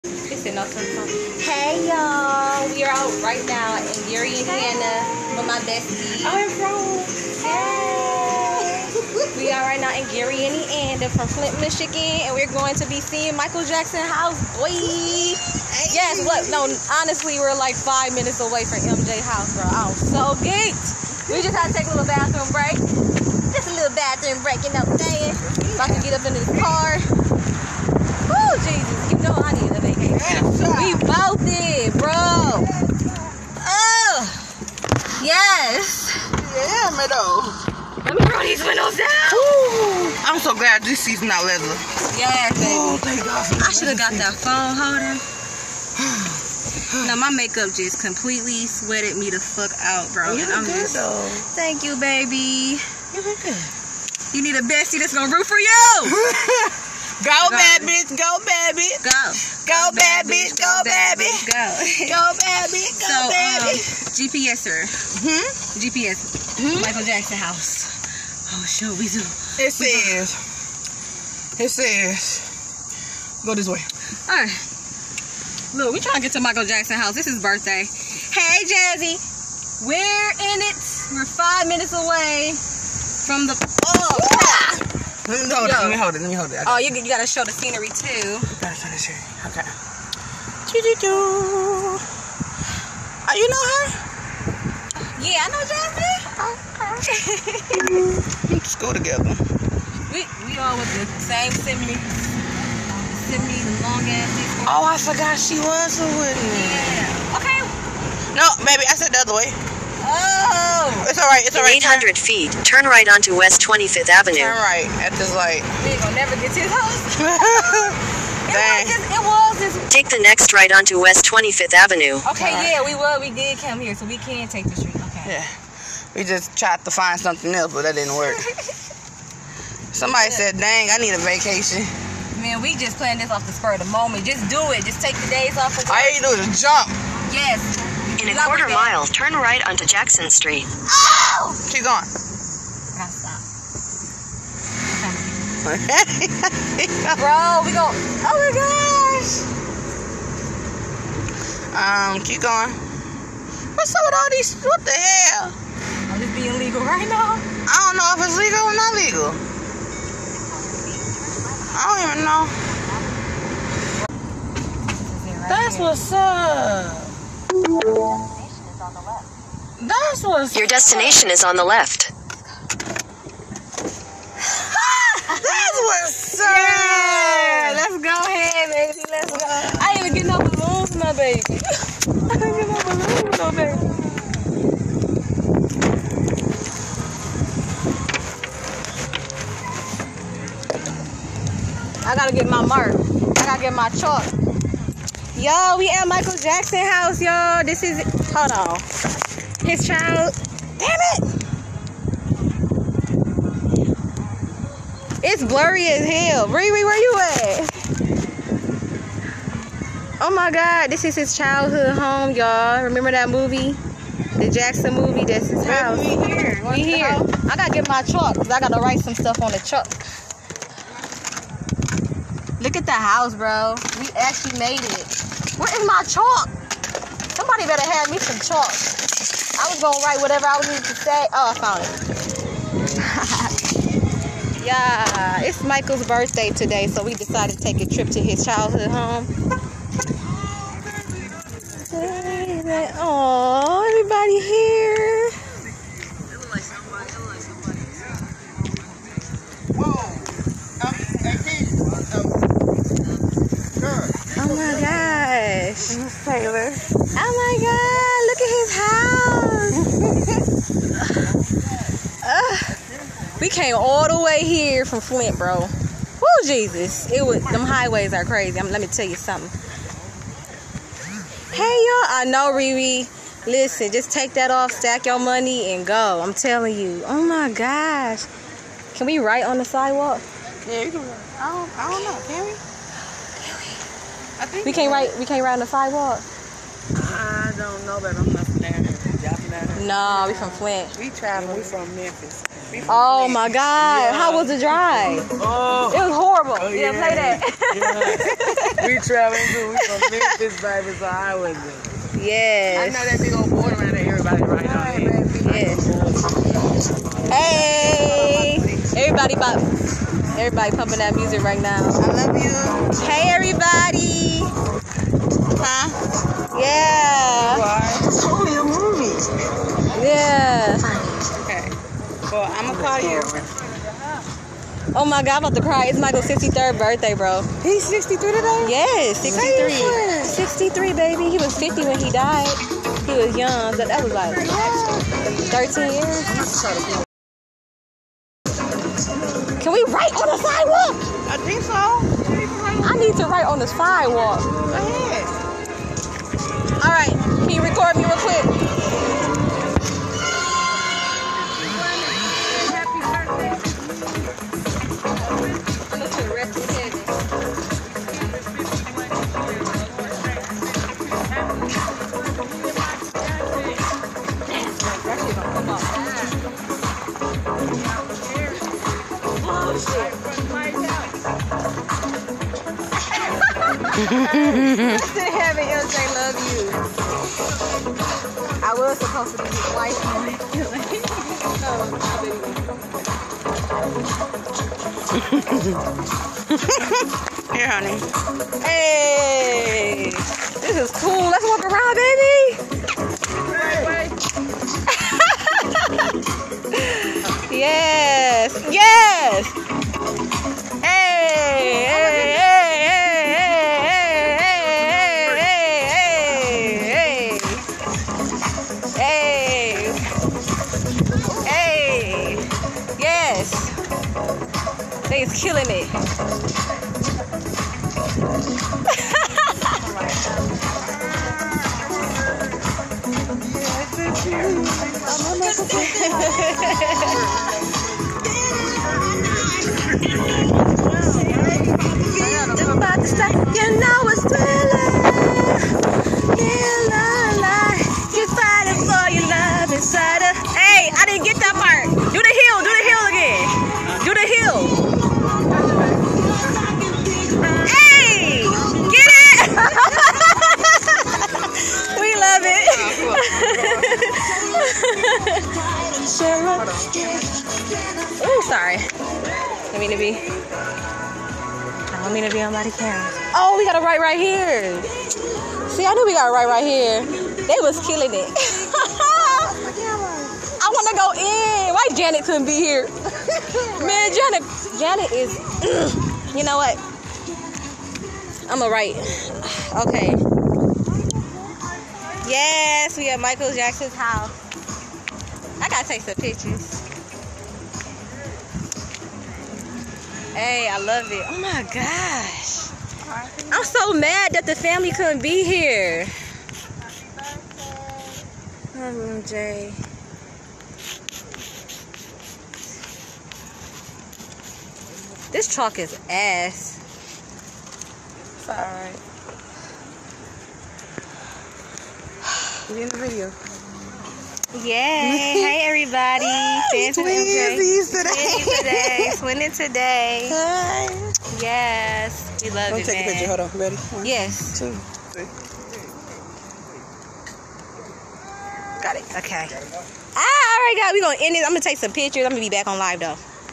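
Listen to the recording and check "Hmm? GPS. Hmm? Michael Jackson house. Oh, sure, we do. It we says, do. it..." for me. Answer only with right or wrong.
right.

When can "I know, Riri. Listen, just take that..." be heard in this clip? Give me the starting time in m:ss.
4:32.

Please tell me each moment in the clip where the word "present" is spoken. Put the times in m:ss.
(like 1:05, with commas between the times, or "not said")
not said.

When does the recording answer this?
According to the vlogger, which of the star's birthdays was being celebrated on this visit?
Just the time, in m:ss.
5:26.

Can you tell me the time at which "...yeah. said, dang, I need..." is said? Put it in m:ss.
2:10.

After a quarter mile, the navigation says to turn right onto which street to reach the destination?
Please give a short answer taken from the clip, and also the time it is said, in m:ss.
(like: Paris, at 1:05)
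Jackson Street, at 2:19.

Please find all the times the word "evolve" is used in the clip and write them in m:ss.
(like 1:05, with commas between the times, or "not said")
not said.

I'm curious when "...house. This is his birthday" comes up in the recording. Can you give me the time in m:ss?
1:16.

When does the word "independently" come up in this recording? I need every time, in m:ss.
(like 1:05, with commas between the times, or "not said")
not said.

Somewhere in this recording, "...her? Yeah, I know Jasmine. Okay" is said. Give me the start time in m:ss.
1:33.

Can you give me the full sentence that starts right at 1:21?
We're five minutes away from the...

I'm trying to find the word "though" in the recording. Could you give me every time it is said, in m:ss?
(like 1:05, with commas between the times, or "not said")
0:37, 0:50, 8:52.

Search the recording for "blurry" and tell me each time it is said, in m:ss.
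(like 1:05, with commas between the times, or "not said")
3:25.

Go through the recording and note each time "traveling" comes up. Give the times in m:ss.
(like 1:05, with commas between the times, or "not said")
4:51, 4:58.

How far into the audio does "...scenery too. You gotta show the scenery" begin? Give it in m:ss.
1:27.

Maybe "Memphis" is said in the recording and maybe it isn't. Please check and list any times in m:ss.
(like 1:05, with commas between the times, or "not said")
4:51, 5:00.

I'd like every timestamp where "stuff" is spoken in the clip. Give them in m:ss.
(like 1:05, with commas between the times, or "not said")
3:39.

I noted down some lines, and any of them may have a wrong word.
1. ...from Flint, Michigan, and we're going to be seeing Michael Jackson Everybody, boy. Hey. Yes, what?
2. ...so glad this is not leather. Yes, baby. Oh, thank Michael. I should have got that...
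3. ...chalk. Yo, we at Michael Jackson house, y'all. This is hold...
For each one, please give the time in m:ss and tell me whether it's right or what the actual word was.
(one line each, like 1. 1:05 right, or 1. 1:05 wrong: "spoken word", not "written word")
1. 0:11 wrong: "House", not "Everybody"
2. 0:40 wrong: "God", not "Michael"
3. 3:13 right.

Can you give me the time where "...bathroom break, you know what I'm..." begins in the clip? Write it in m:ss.
0:23.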